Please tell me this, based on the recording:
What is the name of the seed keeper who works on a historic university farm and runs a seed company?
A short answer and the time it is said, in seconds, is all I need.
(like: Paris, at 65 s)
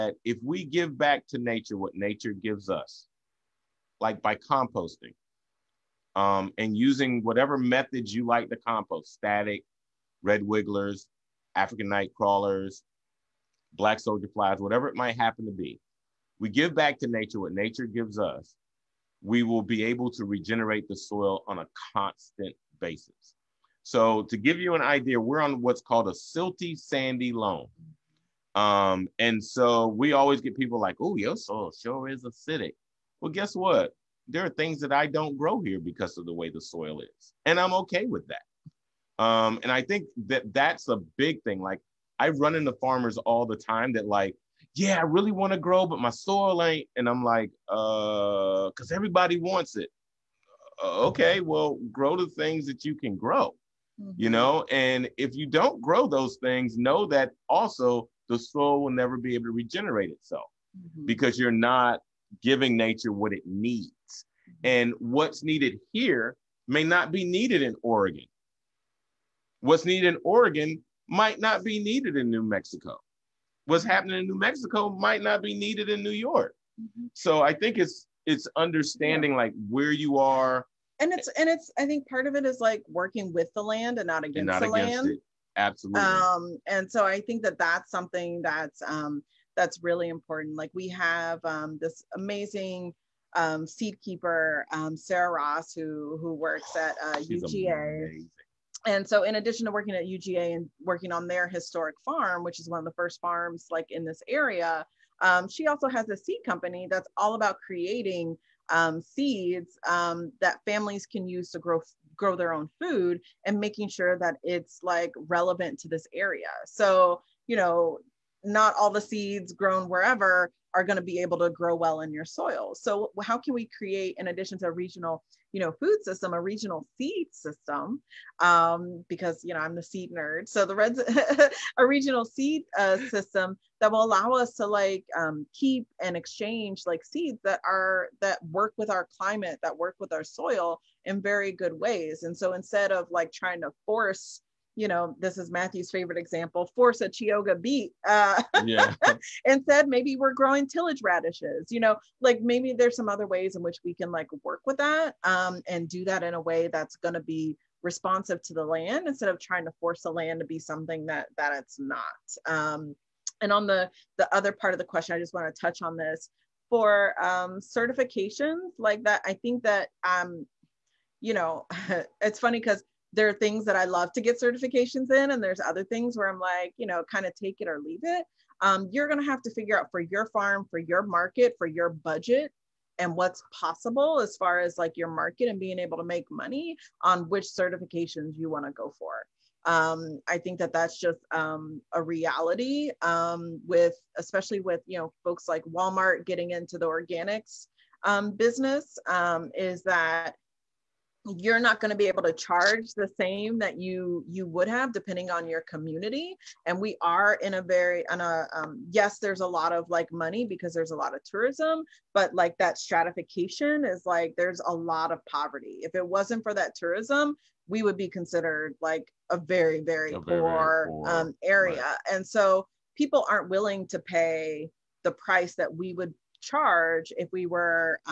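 Sarah Ross, at 94 s.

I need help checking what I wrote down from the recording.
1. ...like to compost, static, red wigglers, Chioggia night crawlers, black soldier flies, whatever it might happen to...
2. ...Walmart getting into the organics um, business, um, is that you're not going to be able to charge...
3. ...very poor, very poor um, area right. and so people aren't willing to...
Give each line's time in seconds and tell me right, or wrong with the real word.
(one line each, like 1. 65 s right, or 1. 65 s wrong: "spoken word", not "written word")
1. 8 s wrong: "African", not "Chioggia"
2. 195 s right
3. 220 s right.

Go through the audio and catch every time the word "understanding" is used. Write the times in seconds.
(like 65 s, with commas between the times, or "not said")
78 s.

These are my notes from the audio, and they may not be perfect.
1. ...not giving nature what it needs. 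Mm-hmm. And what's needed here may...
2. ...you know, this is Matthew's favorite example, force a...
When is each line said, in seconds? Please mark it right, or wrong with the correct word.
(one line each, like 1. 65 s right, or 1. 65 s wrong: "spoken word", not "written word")
1. 61 s right
2. 144 s right.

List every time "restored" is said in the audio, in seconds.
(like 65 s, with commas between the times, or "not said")
not said.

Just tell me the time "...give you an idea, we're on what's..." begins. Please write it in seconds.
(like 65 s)
24 s.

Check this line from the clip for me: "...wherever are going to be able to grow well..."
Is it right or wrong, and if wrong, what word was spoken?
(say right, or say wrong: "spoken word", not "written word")
right.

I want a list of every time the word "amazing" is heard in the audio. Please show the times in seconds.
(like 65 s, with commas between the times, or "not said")
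92 s, 97 s.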